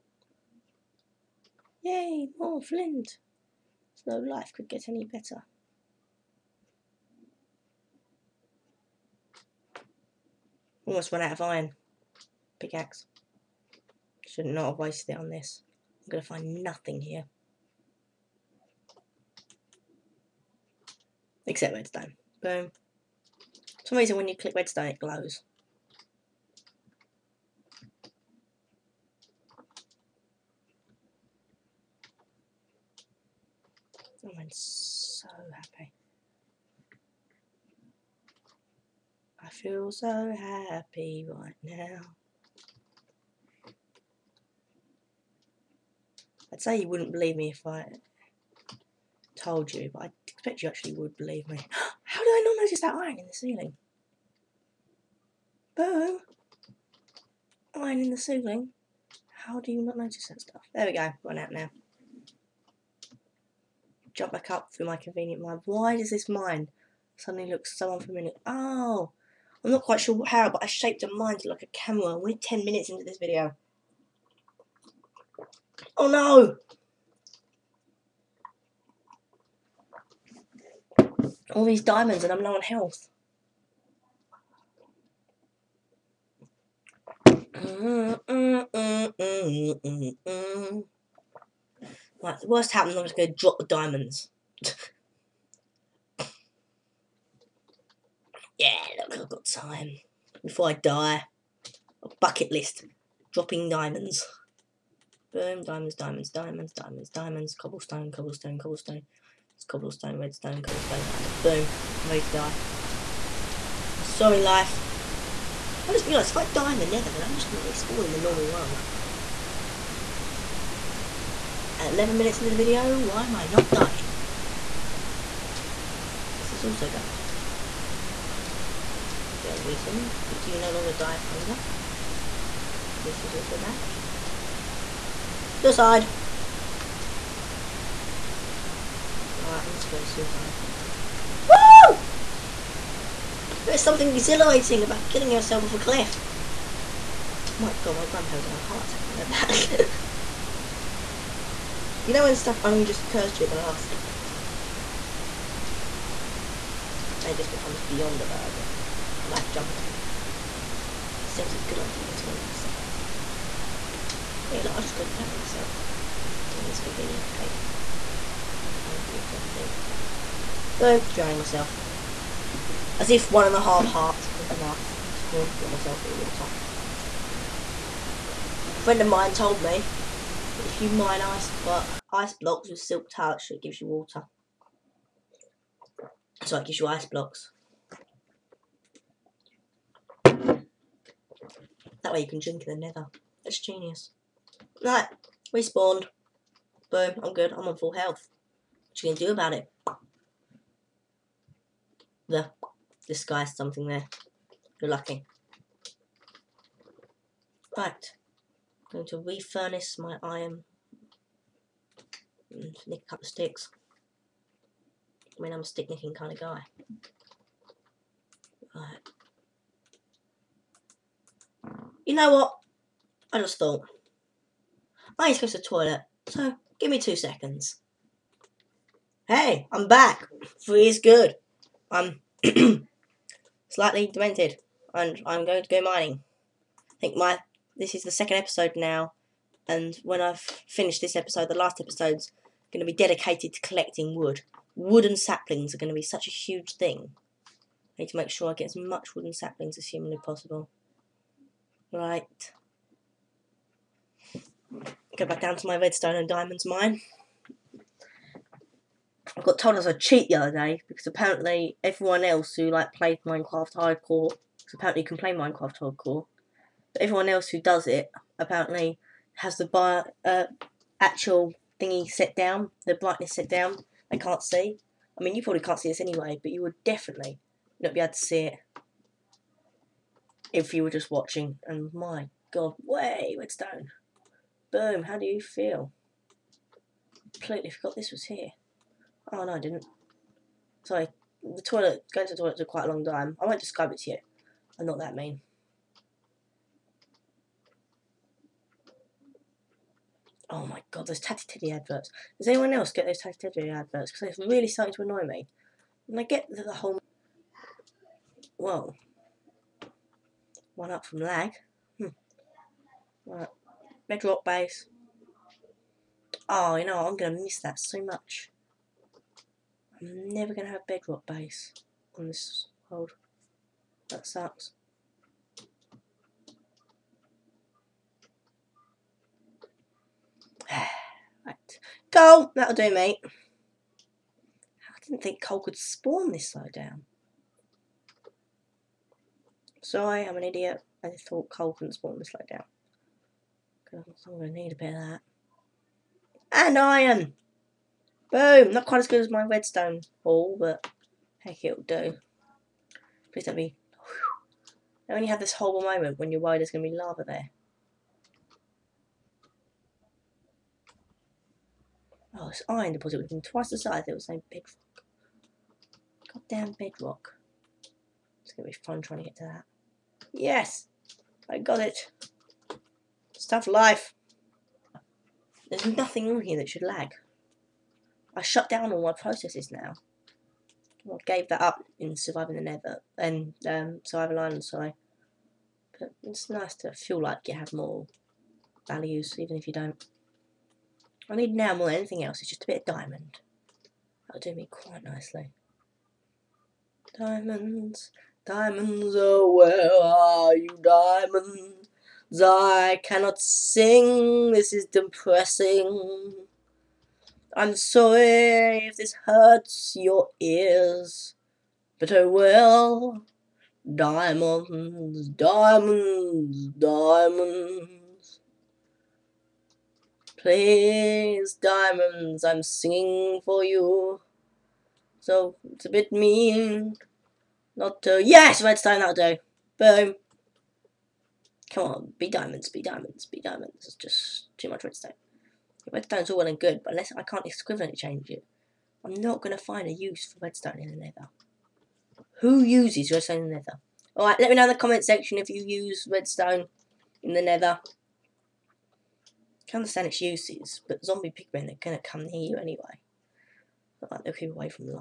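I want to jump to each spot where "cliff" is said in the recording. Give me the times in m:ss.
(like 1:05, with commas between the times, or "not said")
2:25, 2:39.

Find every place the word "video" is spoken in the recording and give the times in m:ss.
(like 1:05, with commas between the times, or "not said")
1:13, 2:02.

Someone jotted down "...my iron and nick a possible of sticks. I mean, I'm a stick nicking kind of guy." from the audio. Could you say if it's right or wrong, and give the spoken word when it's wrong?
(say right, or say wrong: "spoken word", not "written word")
wrong: "couple", not "possible".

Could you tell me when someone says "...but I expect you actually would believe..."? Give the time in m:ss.
0:49.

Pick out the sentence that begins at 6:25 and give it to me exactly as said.
But it's nice to feel like you have more values, even if you don't.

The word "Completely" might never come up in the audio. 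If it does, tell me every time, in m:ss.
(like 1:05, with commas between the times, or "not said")
4:47.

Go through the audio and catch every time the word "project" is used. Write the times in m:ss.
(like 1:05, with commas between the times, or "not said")
not said.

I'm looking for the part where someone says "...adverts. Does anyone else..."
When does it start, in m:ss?
5:01.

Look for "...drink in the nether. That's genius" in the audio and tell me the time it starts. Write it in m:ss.
3:12.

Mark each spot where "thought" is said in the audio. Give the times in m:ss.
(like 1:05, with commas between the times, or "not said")
3:43, 5:41.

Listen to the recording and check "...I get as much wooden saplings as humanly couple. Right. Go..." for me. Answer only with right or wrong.
wrong.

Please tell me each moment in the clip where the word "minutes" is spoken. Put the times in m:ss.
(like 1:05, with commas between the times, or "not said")
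1:12, 2:02.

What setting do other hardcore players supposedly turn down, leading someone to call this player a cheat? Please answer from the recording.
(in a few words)
Brightness.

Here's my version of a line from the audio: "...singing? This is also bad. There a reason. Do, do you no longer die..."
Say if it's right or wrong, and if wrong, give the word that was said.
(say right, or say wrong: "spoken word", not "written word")
wrong: "dying", not "singing".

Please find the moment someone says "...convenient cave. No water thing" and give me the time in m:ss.
2:46.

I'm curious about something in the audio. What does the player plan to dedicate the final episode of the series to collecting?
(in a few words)
Wood.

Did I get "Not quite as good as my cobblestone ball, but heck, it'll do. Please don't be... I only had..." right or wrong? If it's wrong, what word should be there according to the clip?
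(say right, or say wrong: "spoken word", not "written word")
wrong: "redstone", not "cobblestone".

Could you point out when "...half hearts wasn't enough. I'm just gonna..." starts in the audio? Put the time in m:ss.
2:53.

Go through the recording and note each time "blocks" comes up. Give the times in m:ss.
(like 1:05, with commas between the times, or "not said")
3:02, 3:07.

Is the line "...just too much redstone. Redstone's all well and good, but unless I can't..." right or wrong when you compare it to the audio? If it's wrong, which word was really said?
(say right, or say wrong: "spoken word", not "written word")
right.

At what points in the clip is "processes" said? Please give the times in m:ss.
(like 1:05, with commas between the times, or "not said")
6:19.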